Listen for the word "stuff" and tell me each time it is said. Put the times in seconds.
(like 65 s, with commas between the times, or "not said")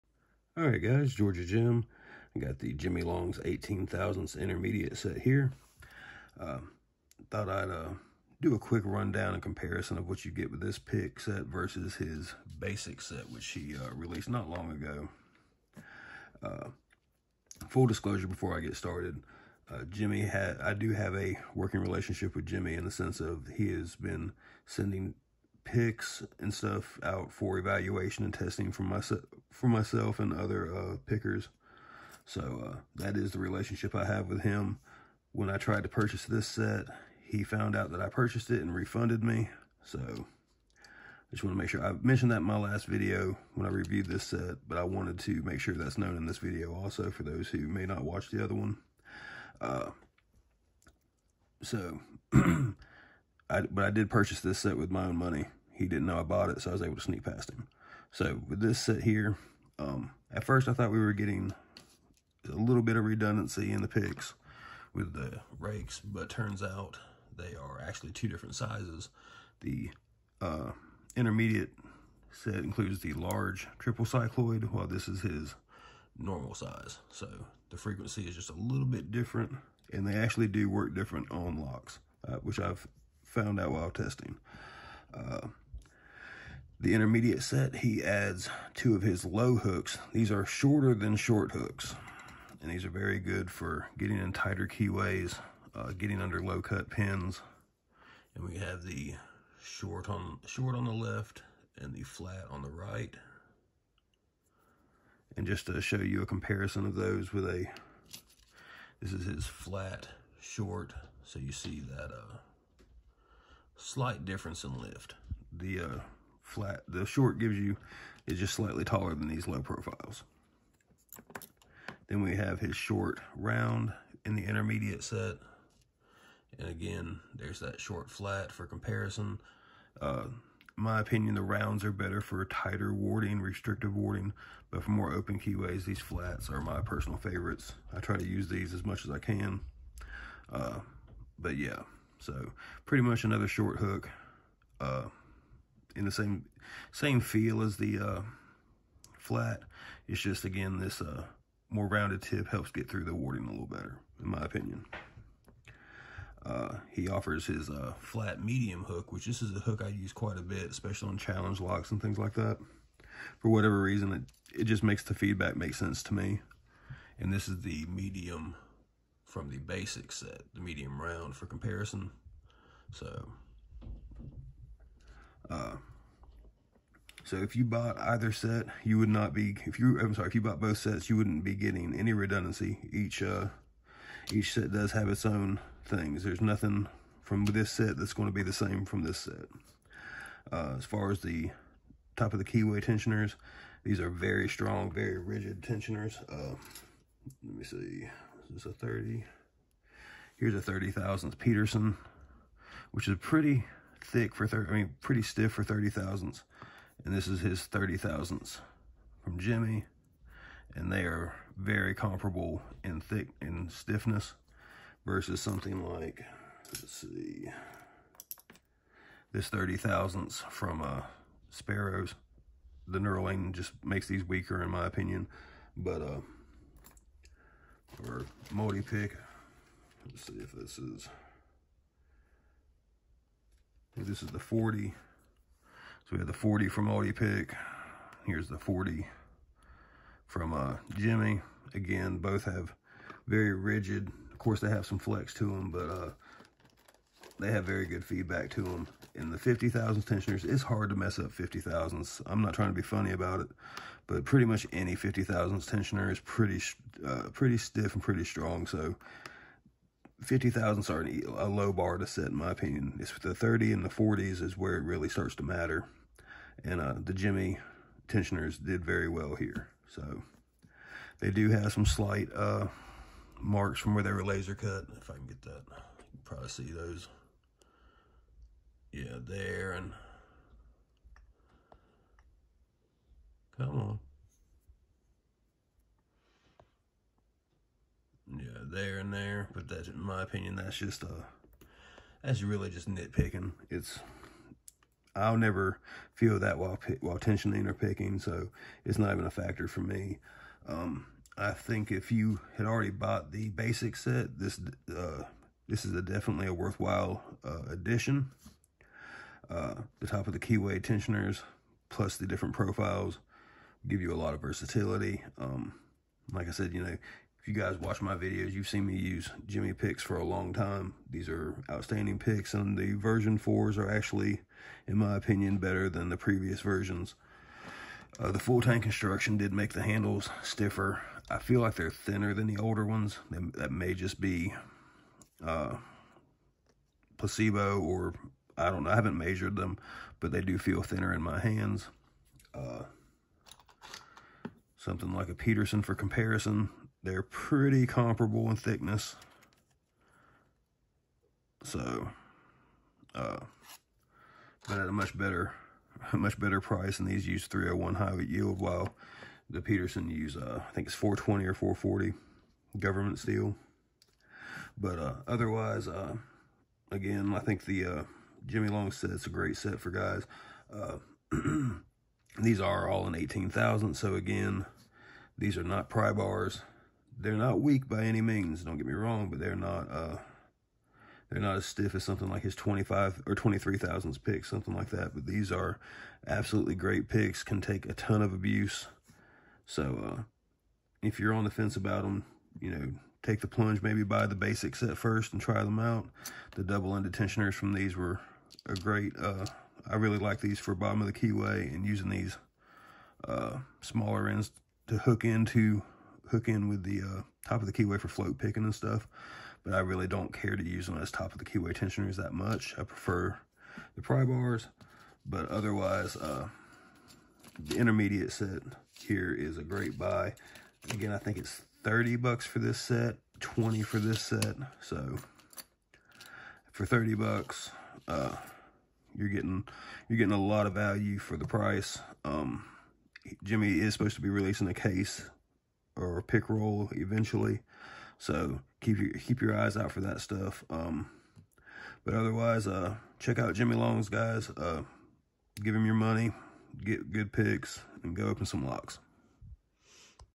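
26 s, 408 s, 440 s.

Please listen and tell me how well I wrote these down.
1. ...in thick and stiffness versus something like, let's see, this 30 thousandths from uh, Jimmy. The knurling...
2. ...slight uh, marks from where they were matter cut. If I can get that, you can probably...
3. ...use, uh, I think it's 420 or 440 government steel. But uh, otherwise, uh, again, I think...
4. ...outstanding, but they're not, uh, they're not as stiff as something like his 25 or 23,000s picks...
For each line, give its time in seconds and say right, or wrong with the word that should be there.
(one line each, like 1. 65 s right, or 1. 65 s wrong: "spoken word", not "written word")
1. 212 s wrong: "Sparrows", not "Jimmy"
2. 271 s wrong: "laser", not "matter"
3. 360 s right
4. 378 s wrong: "wrong", not "outstanding".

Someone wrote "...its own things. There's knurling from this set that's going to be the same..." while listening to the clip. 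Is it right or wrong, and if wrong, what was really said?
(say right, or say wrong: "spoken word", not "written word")
wrong: "nothing", not "knurling".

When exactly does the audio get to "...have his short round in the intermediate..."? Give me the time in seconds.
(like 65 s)
122 s.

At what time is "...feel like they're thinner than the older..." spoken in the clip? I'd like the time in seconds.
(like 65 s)
331 s.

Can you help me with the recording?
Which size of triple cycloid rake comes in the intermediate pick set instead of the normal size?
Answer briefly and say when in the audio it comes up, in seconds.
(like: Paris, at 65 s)
Large, at 73 s.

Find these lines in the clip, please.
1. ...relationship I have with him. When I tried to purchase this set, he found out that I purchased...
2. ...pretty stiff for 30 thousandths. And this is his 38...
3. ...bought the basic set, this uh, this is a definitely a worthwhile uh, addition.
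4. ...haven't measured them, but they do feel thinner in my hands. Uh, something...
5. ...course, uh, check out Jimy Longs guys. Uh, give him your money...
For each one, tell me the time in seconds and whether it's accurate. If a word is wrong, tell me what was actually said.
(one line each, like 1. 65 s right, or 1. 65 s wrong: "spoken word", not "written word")
1. 33 s right
2. 204 s wrong: "30", not "38"
3. 302 s right
4. 338 s right
5. 442 s wrong: "otherwise", not "course".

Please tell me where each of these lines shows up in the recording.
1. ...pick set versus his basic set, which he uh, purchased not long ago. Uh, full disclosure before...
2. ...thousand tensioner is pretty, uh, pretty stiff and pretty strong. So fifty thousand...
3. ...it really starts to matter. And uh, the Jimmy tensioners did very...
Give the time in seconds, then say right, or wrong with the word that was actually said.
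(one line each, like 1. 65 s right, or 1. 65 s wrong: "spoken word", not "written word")
1. 10 s wrong: "released", not "purchased"
2. 255 s right
3. 264 s right.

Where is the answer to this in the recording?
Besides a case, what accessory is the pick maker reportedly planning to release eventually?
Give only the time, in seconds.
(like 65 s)
436 s.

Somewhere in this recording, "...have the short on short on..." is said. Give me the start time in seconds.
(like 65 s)
98 s.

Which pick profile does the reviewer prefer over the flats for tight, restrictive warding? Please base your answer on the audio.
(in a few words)
The rounds.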